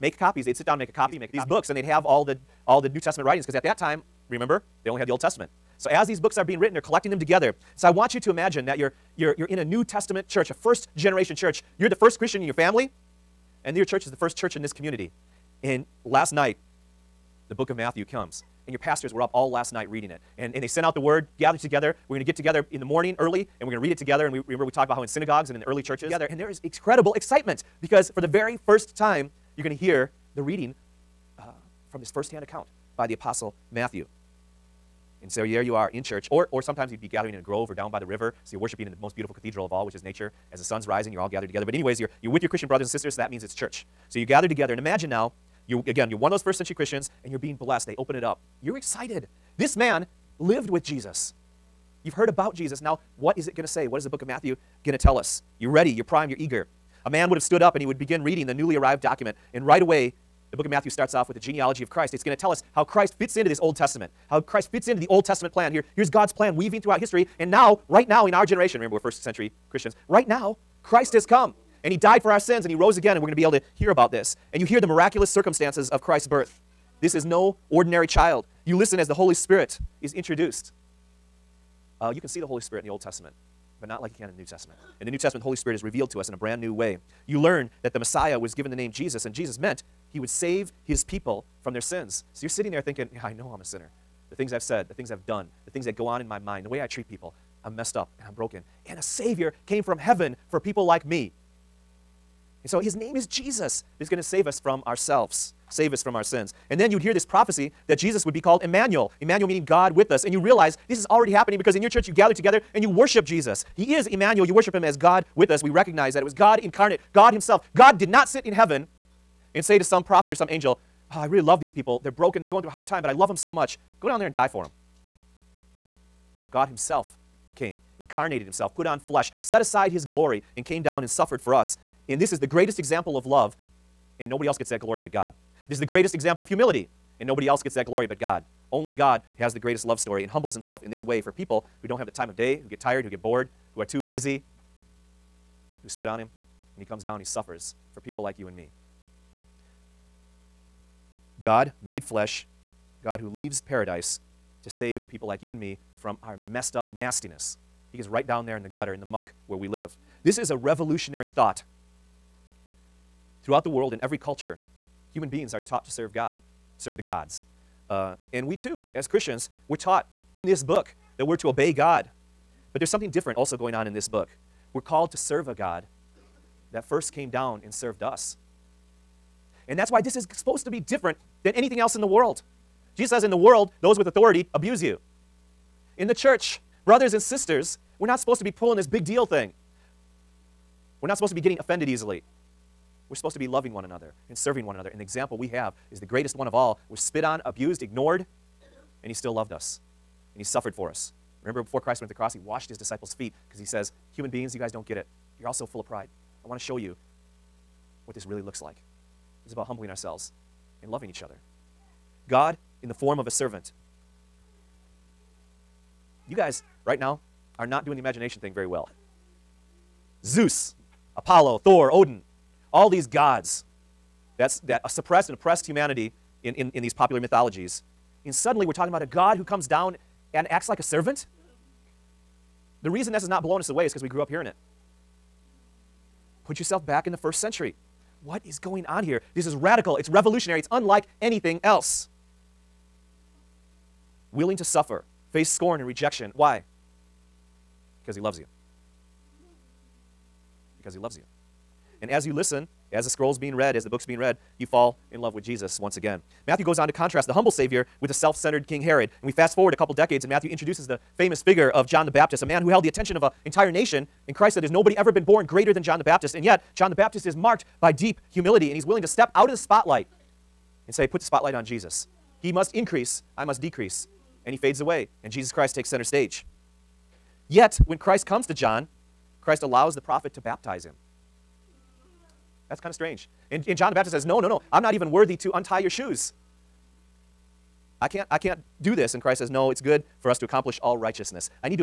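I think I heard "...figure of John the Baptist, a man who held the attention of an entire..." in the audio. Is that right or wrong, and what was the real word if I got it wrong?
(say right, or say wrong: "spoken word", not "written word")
right.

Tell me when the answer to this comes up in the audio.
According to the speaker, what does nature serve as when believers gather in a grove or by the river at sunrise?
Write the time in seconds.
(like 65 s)
38 s.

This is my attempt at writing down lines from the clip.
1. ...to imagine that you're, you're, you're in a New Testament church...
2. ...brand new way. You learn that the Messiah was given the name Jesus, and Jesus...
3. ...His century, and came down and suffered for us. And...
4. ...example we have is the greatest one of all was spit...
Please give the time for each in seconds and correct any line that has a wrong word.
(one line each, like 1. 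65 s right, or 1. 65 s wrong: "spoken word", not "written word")
1. 8 s right
2. 86 s right
3. 129 s wrong: "glory", not "century"
4. 195 s right.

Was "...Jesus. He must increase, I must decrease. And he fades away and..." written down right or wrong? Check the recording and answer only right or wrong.
right.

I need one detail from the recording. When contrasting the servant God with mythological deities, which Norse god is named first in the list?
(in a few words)
Thor.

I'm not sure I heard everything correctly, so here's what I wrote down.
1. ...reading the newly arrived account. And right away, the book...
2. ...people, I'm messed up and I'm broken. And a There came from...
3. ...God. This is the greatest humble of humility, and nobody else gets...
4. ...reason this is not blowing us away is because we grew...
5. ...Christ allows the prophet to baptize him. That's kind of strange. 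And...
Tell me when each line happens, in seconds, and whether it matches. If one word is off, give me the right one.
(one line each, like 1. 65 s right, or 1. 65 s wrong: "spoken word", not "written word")
1. 58 s wrong: "document", not "account"
2. 97 s wrong: "Savior", not "There"
3. 135 s wrong: "example", not "humble"
4. 232 s right
5. 279 s right.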